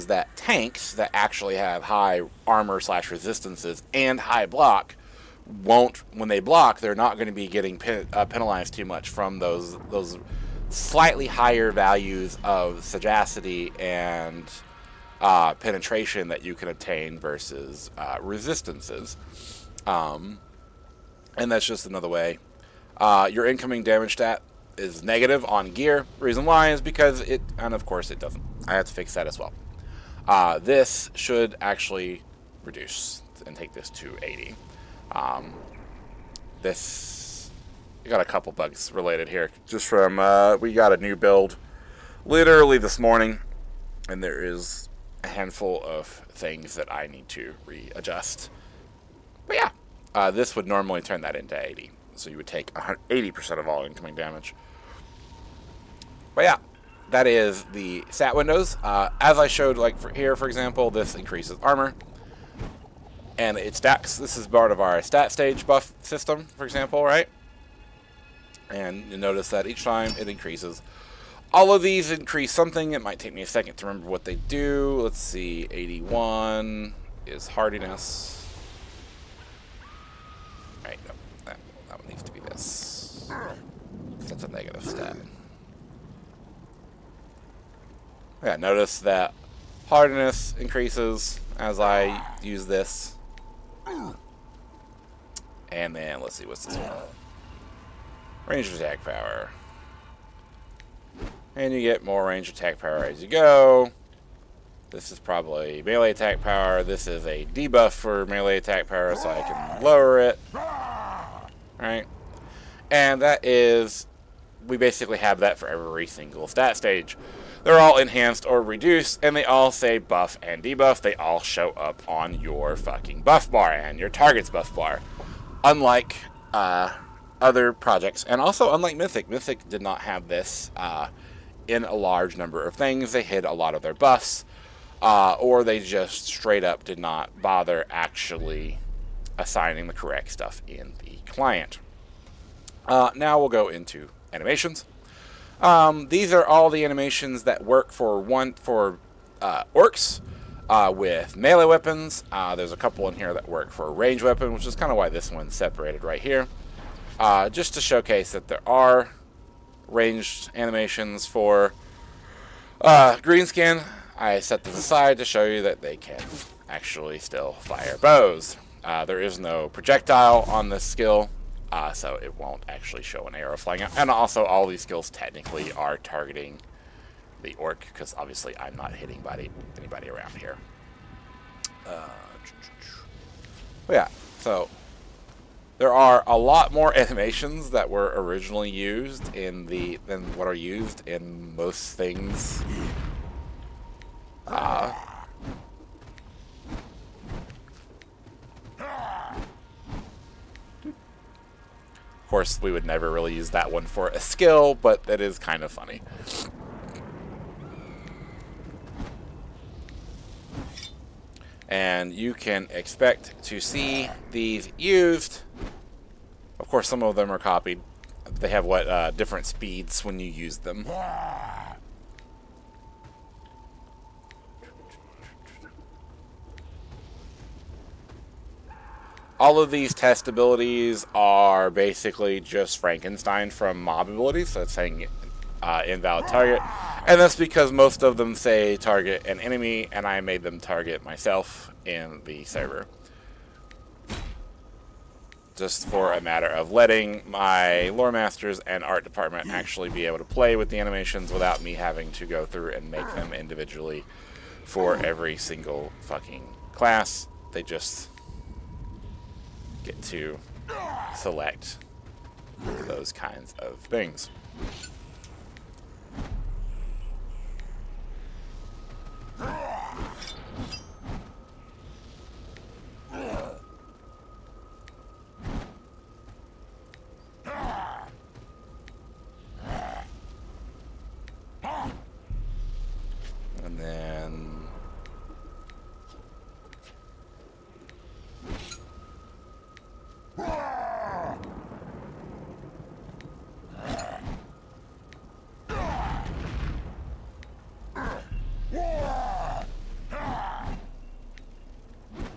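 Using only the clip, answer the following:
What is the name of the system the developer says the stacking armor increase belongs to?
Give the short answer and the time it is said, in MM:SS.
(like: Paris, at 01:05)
stat stage buff system, at 01:05.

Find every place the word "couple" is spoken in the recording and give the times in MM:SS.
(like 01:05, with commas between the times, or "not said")
00:38, 02:32.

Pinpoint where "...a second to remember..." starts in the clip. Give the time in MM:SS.
01:13.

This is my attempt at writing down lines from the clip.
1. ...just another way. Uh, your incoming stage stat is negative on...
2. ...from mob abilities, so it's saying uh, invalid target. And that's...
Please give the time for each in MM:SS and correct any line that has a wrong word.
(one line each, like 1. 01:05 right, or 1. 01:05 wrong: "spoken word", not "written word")
1. 00:21 wrong: "damage", not "stage"
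2. 03:53 right.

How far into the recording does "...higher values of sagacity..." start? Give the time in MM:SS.
00:11.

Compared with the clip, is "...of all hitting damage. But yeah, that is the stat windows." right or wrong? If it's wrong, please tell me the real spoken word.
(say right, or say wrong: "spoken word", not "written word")
wrong: "incoming", not "hitting".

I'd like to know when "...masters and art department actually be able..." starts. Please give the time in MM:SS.
04:08.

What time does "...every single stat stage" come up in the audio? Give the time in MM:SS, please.
01:55.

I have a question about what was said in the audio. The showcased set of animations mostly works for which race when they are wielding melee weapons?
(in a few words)
orcs.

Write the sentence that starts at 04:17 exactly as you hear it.
They just get to select those kinds of things.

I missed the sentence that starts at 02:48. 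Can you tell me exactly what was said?
Uh, there is no projectile on this skill, uh, so it won't actually show an arrow flying out.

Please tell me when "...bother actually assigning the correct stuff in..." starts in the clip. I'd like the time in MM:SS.
02:17.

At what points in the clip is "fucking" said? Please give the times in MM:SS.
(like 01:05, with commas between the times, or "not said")
02:02, 04:16.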